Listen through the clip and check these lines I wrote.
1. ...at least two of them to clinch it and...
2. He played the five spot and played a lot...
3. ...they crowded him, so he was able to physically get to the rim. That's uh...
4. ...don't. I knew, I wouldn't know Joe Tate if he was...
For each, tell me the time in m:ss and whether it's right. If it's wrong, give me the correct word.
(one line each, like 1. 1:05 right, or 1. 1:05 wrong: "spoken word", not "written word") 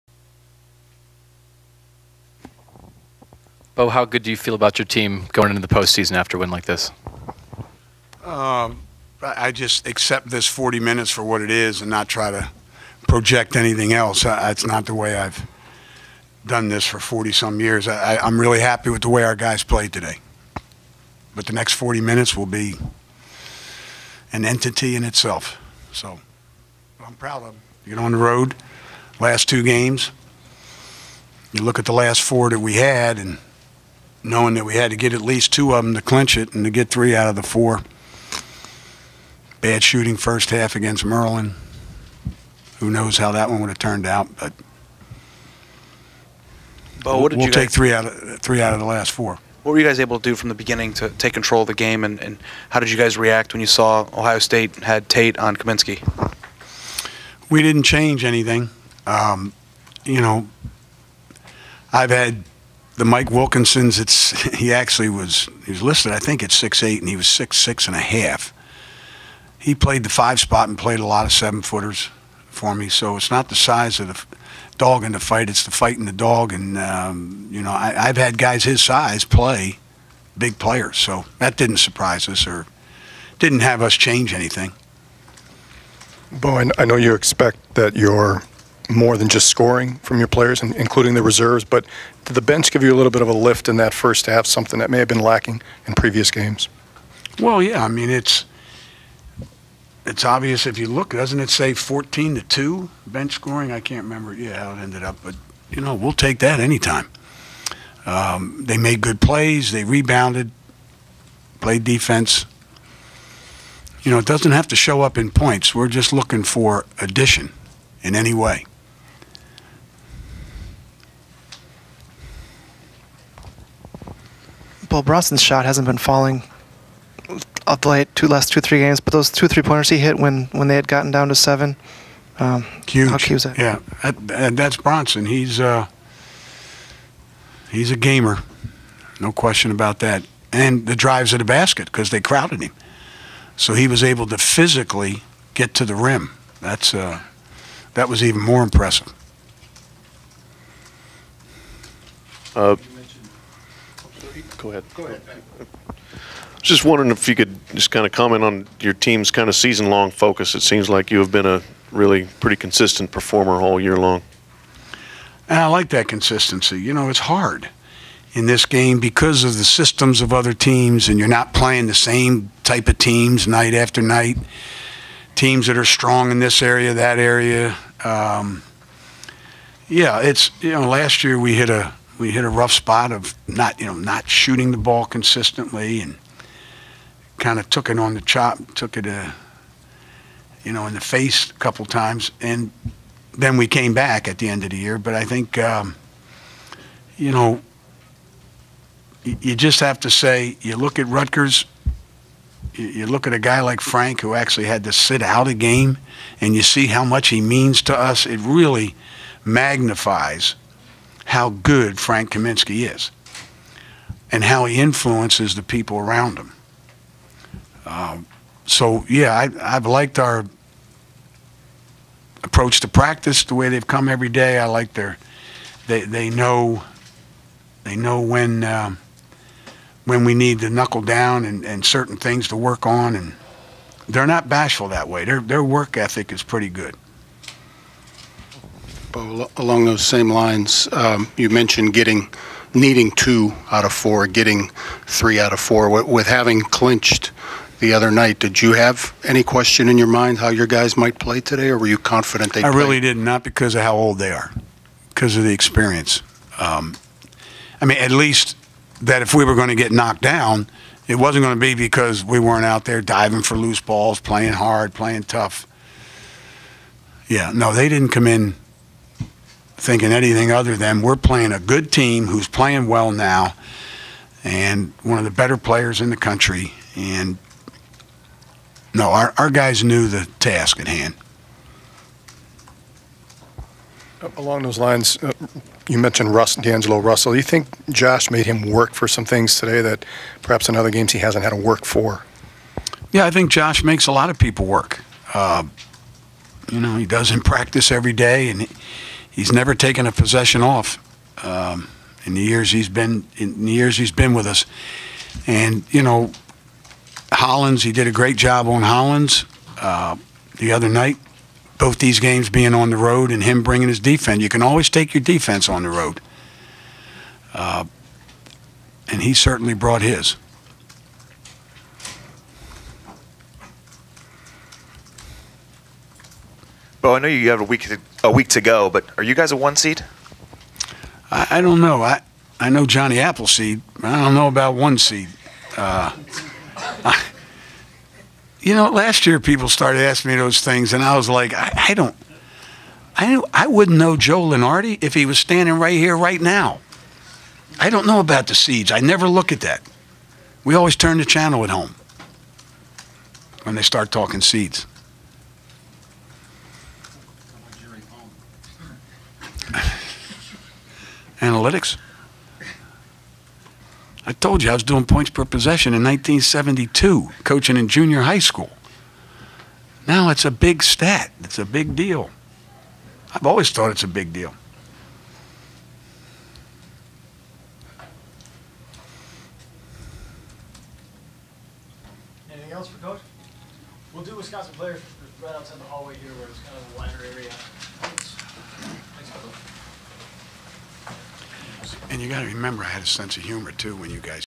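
1. 0:35 right
2. 1:09 right
3. 2:22 right
4. 5:41 wrong: "Lunardi", not "Tate".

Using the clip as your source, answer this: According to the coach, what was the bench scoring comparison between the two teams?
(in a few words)
14 to 2.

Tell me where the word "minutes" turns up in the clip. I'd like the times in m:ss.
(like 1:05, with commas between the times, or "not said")
0:10, 0:22.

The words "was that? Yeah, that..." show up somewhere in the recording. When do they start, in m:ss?
2:13.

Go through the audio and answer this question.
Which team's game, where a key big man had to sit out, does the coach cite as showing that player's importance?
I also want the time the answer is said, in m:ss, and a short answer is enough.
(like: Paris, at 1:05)
Rutgers, at 3:21.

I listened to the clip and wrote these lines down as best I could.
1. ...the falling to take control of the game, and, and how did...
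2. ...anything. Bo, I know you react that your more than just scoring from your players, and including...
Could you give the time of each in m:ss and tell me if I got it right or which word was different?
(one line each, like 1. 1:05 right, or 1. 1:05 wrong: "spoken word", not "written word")
1. 0:50 wrong: "beginning", not "falling"
2. 1:24 wrong: "expect", not "react".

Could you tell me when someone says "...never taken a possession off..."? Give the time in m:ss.
4:59.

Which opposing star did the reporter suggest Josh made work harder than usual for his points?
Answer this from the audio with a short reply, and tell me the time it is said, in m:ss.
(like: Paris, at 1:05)
D'Angelo Russell, at 4:46.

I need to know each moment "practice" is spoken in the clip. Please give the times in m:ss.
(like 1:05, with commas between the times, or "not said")
3:42, 4:57.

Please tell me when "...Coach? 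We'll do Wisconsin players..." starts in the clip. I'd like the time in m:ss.
6:23.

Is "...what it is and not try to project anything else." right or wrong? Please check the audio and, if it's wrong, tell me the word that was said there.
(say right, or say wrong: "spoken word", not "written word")
right.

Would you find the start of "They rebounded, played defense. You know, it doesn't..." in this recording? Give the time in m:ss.
1:49.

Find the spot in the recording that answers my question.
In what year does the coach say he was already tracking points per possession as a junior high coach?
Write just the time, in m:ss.
6:06.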